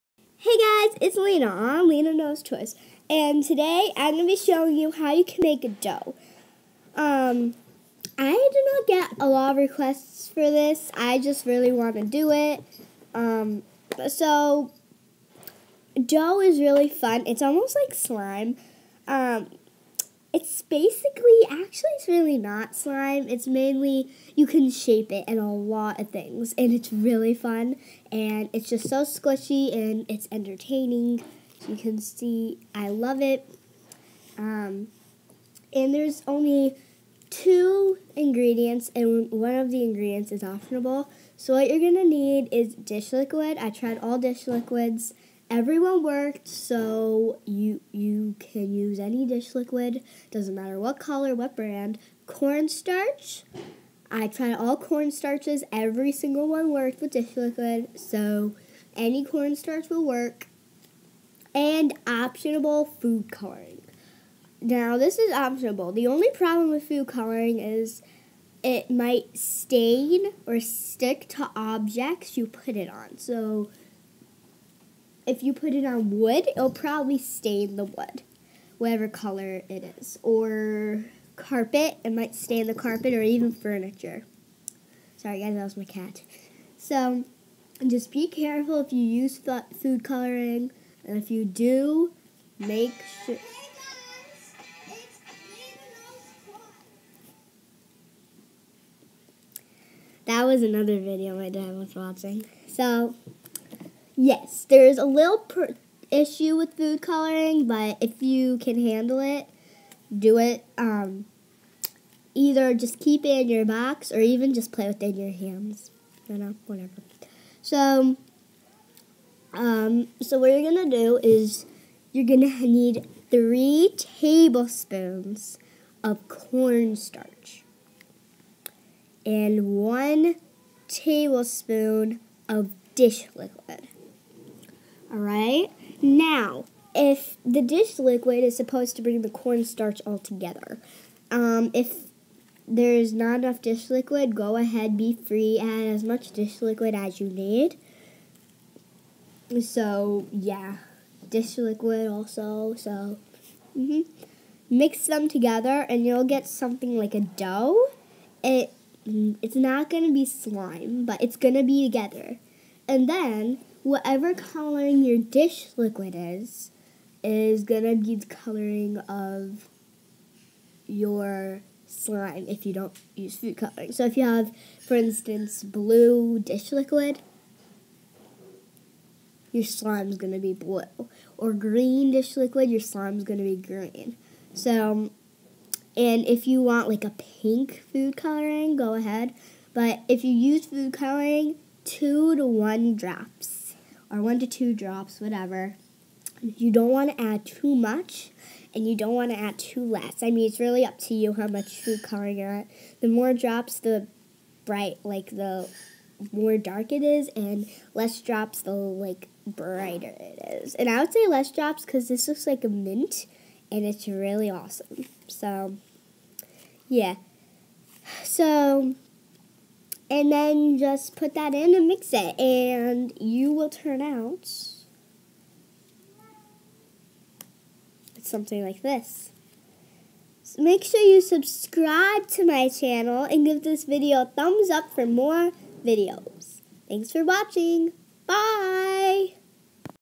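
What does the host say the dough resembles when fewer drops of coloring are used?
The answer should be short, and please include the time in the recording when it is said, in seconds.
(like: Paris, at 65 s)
mint, at 212 s.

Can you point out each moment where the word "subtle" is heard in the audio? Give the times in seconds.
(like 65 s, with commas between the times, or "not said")
not said.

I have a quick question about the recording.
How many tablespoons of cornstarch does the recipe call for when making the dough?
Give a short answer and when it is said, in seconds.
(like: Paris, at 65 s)
3, at 123 s.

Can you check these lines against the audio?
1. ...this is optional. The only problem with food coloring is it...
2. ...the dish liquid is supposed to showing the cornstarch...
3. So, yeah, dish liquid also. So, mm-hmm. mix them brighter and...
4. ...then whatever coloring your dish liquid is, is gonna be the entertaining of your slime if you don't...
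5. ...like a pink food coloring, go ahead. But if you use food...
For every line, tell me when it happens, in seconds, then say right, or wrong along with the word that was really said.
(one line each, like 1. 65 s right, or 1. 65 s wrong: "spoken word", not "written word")
1. 64 s right
2. 137 s wrong: "bring", not "showing"
3. 149 s wrong: "together", not "brighter"
4. 163 s wrong: "coloring", not "entertaining"
5. 186 s right.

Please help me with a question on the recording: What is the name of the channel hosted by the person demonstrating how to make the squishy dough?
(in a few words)
Lena Knows Toys.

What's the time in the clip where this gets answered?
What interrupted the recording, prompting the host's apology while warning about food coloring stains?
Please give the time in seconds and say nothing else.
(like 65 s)
85 s.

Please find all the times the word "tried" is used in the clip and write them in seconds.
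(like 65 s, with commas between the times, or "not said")
43 s, 54 s.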